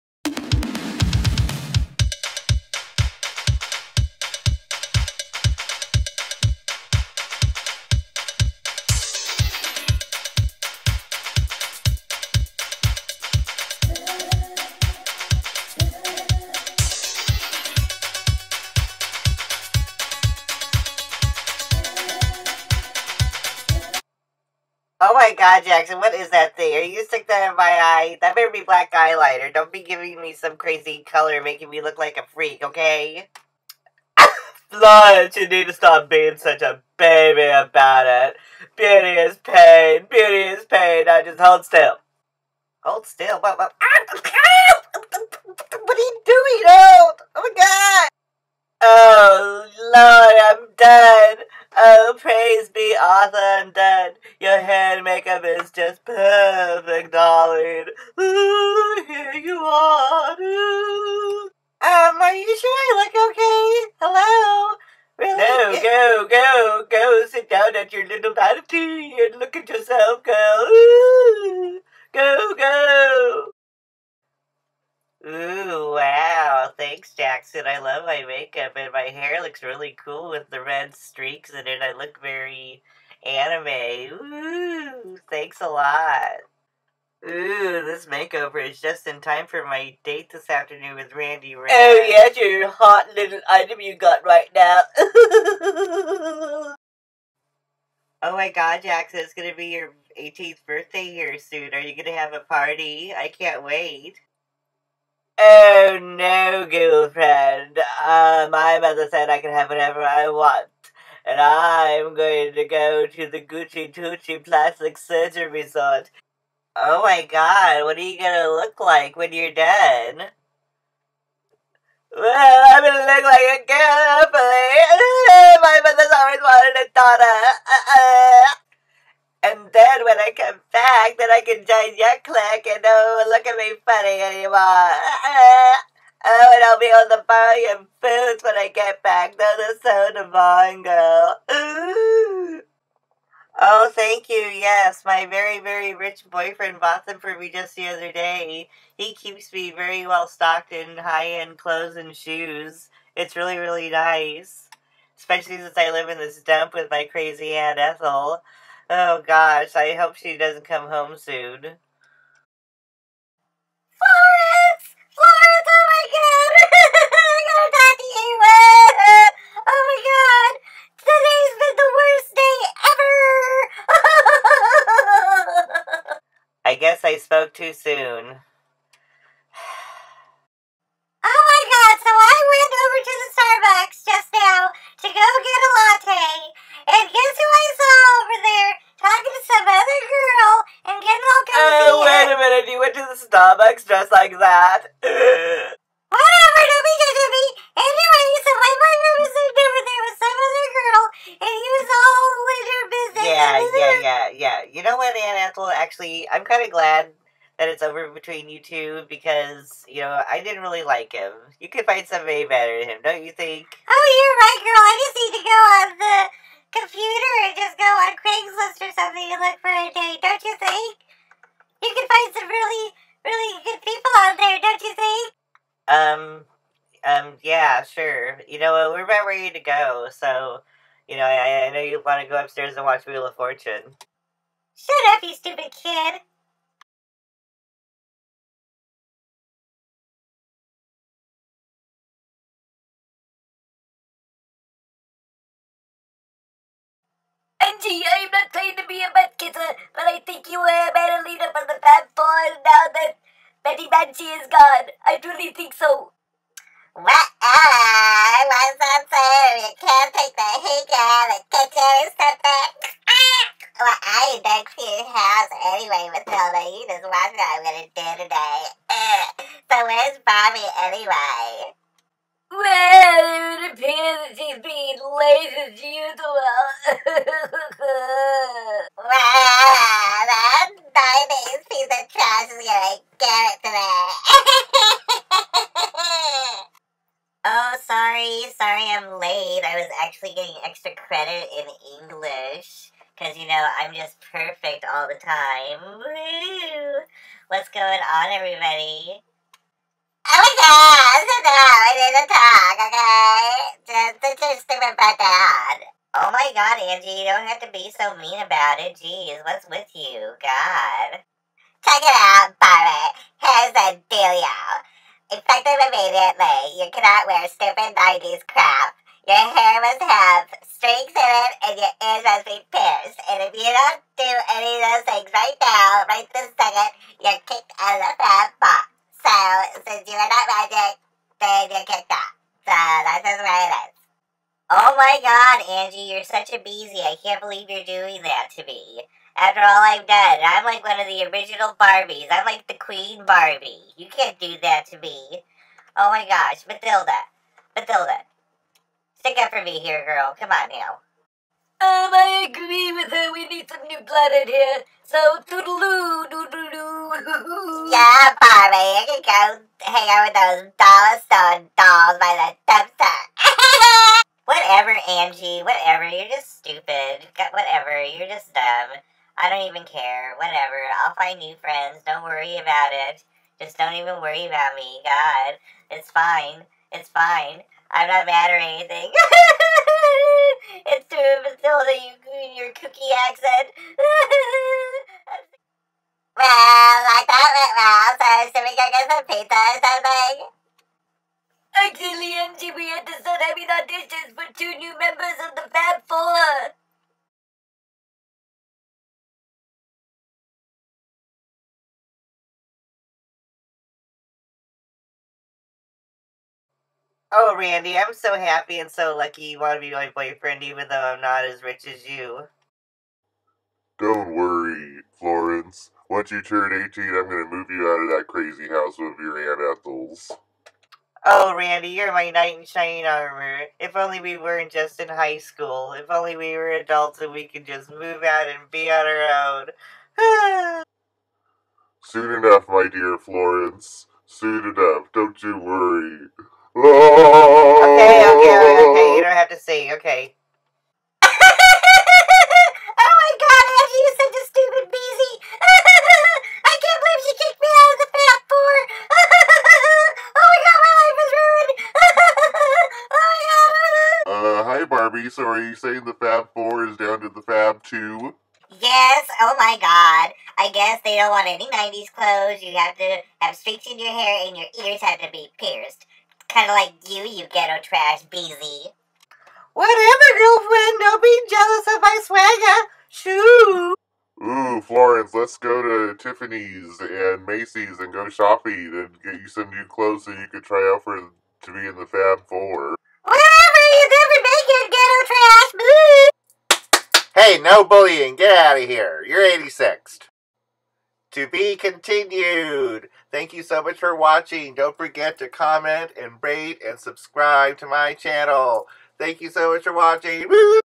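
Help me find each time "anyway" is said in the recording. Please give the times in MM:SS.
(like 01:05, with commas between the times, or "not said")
04:25, 04:30.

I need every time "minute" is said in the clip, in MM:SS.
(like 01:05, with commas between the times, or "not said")
03:12.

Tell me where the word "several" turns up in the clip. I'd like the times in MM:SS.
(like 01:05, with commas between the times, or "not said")
not said.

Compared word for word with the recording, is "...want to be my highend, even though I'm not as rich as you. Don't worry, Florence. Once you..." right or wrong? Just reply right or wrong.
wrong.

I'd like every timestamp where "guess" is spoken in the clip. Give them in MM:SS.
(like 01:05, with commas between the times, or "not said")
03:07, 07:40.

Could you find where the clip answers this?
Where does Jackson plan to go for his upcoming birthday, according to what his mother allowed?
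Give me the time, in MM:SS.
01:53.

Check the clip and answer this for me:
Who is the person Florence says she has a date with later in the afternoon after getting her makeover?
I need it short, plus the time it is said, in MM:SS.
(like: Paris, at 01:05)
Randy Ray, at 01:31.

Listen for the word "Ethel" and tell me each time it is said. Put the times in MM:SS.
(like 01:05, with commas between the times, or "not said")
02:37, 06:59.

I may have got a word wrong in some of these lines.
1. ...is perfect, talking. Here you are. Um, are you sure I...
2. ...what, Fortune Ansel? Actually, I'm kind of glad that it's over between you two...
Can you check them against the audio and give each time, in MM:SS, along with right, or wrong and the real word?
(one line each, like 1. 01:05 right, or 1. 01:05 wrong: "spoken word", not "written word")
1. 00:55 wrong: "darling", not "talking"
2. 03:24 wrong: "Anne", not "Fortune".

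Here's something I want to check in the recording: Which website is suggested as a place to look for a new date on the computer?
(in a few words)
Craigslist.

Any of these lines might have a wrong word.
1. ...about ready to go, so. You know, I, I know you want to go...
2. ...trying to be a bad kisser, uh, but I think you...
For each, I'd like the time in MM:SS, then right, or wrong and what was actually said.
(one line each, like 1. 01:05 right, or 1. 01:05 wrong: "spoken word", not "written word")
1. 03:49 right
2. 04:08 right.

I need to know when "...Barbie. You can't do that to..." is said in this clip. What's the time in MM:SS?
05:43.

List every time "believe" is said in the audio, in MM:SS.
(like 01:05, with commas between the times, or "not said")
05:37, 07:27.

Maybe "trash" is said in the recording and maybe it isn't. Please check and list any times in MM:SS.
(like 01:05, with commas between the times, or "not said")
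04:42, 07:47, 08:06.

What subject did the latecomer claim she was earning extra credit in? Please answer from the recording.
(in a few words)
English.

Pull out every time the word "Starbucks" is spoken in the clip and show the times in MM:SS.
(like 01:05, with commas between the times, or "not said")
03:03, 03:13.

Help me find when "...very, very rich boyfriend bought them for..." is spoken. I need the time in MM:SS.
02:25.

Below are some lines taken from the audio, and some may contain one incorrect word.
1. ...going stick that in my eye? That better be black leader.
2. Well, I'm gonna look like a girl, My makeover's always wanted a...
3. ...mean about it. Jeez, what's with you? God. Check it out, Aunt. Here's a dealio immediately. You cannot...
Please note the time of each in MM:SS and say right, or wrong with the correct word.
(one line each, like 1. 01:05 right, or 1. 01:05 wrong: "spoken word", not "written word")
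1. 00:26 wrong: "eyeliner", not "leader"
2. 02:02 wrong: "mother", not "makeover"
3. 05:08 wrong: "Pirate", not "Aunt".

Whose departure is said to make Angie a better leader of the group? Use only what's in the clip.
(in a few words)
Betty Banshee.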